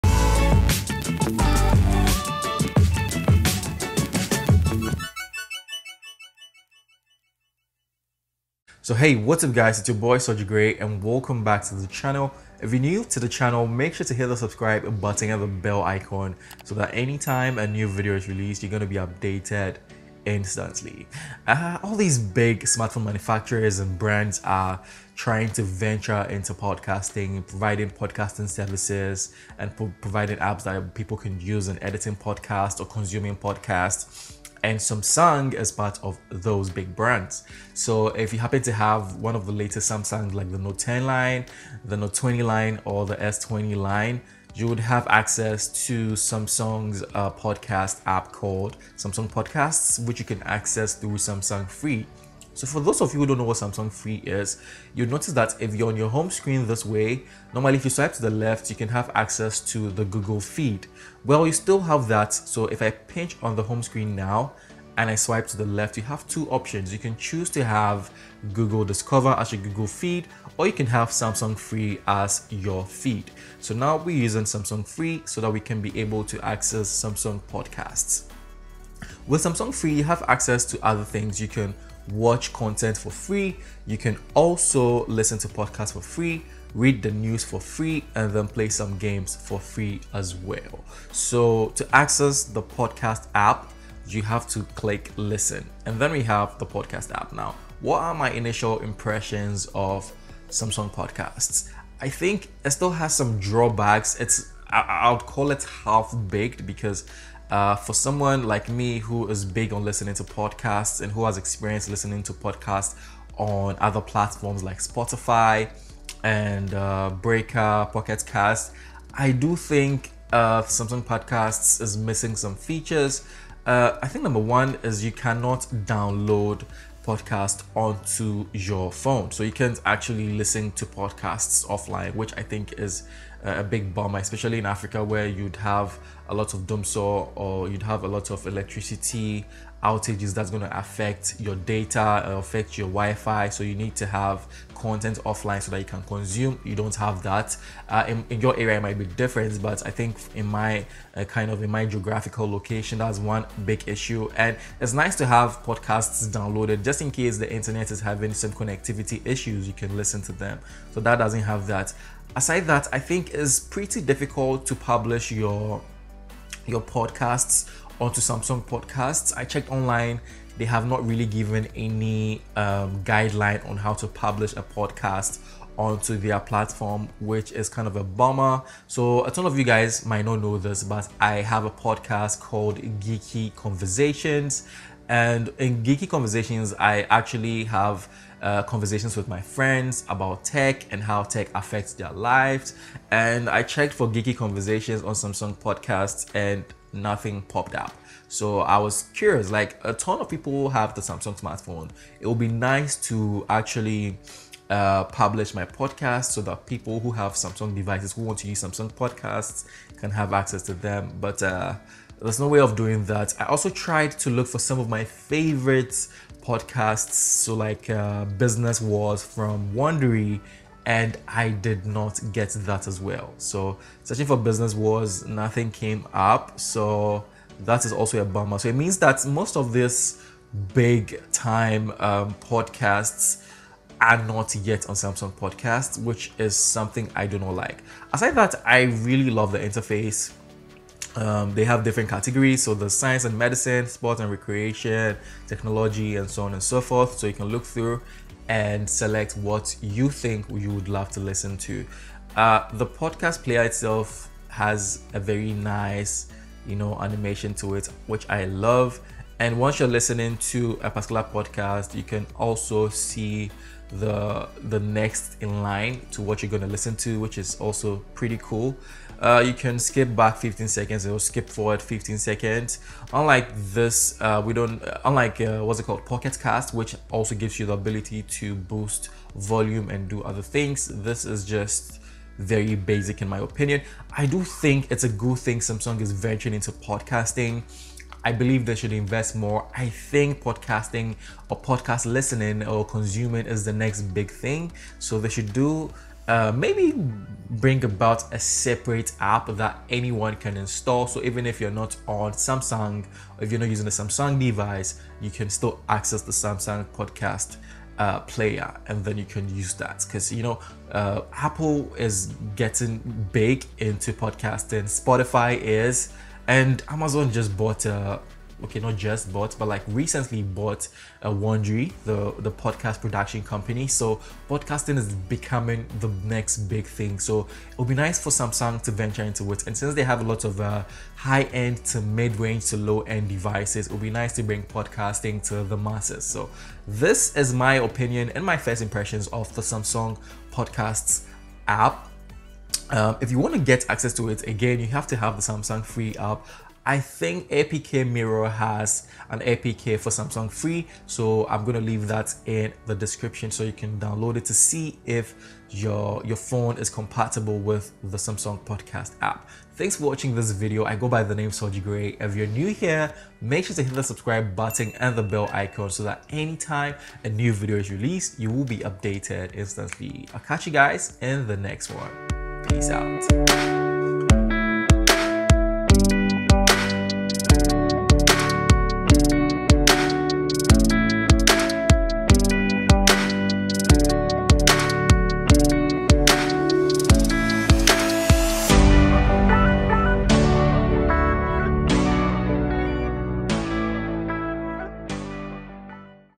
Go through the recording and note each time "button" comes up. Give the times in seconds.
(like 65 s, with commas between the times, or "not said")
14 s, 364 s.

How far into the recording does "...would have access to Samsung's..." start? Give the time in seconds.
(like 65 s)
44 s.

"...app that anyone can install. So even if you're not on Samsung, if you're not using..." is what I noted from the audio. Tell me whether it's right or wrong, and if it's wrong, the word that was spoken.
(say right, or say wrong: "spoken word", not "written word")
right.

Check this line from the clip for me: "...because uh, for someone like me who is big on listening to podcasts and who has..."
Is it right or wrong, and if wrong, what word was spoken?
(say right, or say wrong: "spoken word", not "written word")
right.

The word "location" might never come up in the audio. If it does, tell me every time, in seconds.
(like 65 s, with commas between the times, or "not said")
152 s.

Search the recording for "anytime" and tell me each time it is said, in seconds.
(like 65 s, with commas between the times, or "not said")
16 s, 366 s.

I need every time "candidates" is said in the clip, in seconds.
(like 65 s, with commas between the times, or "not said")
not said.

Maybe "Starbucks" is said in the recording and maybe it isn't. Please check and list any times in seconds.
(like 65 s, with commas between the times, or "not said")
not said.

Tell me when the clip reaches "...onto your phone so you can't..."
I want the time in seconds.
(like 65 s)
127 s.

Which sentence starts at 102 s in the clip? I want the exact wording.
I think it still has some drawbacks.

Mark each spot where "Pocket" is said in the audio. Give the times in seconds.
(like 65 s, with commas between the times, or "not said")
117 s, 276 s.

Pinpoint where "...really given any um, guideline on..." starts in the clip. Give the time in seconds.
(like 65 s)
171 s.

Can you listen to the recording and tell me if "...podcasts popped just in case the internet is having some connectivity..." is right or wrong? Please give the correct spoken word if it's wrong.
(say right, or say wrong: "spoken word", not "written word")
wrong: "downloaded", not "popped".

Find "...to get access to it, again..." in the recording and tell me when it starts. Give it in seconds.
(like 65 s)
343 s.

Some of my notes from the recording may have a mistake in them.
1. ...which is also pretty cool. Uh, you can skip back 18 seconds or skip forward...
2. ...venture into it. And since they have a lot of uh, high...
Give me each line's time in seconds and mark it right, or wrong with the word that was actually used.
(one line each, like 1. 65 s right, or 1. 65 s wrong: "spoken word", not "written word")
1. 267 s wrong: "15", not "18"
2. 328 s right.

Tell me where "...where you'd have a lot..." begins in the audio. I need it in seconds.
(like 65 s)
135 s.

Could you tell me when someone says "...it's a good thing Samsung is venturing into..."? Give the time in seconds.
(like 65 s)
284 s.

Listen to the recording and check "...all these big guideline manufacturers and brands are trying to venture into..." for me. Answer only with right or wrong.
wrong.